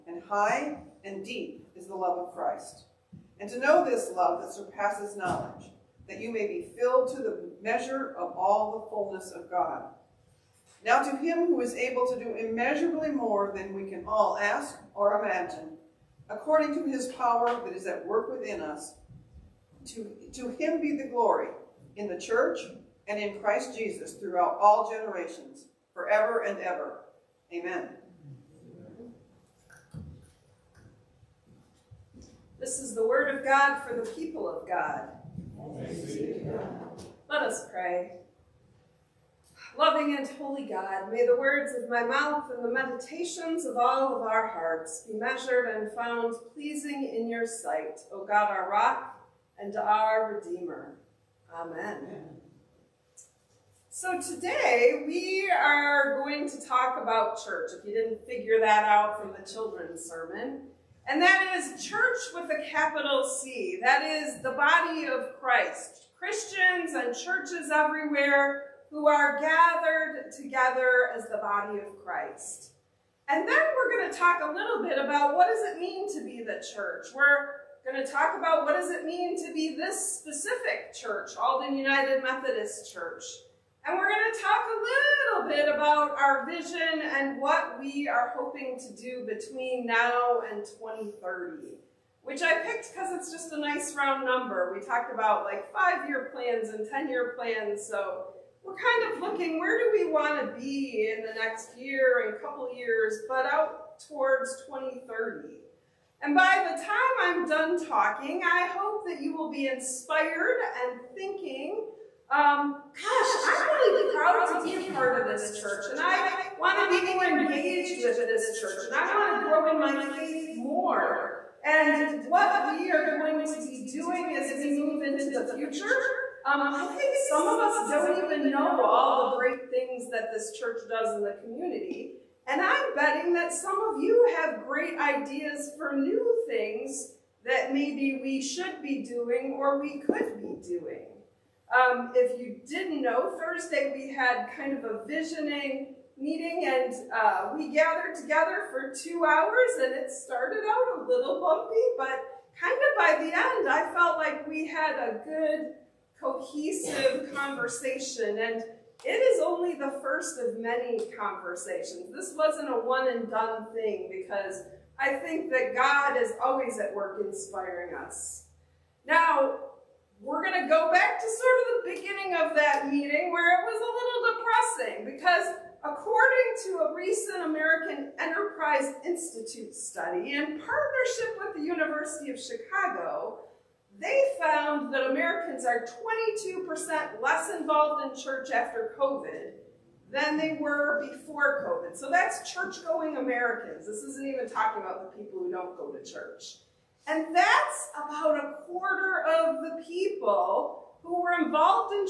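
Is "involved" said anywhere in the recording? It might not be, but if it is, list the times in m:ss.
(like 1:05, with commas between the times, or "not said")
3:07, 3:21.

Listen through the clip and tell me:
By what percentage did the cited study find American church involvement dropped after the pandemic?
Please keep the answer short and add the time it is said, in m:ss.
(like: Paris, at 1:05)
22%, at 3:06.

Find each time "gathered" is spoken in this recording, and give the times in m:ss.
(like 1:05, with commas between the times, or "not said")
1:09, 2:27.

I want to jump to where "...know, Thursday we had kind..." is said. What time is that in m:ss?
2:23.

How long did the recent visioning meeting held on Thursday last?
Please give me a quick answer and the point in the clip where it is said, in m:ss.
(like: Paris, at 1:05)
2 hours, at 2:28.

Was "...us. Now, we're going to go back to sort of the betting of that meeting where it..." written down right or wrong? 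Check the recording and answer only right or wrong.
wrong.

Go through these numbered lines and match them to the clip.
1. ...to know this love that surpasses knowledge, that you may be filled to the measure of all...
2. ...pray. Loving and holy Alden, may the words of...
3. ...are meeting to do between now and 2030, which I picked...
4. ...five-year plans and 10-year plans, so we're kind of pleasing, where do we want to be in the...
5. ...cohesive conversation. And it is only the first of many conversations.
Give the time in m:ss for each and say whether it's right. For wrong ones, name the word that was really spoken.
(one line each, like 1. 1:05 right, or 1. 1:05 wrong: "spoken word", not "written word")
1. 0:03 right
2. 0:37 wrong: "God", not "Alden"
3. 1:28 wrong: "hoping", not "meeting"
4. 1:35 wrong: "looking", not "pleasing"
5. 2:36 right.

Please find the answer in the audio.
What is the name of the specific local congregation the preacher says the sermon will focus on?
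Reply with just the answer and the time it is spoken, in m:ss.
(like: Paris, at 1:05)
Alden United Methodist Church, at 1:21.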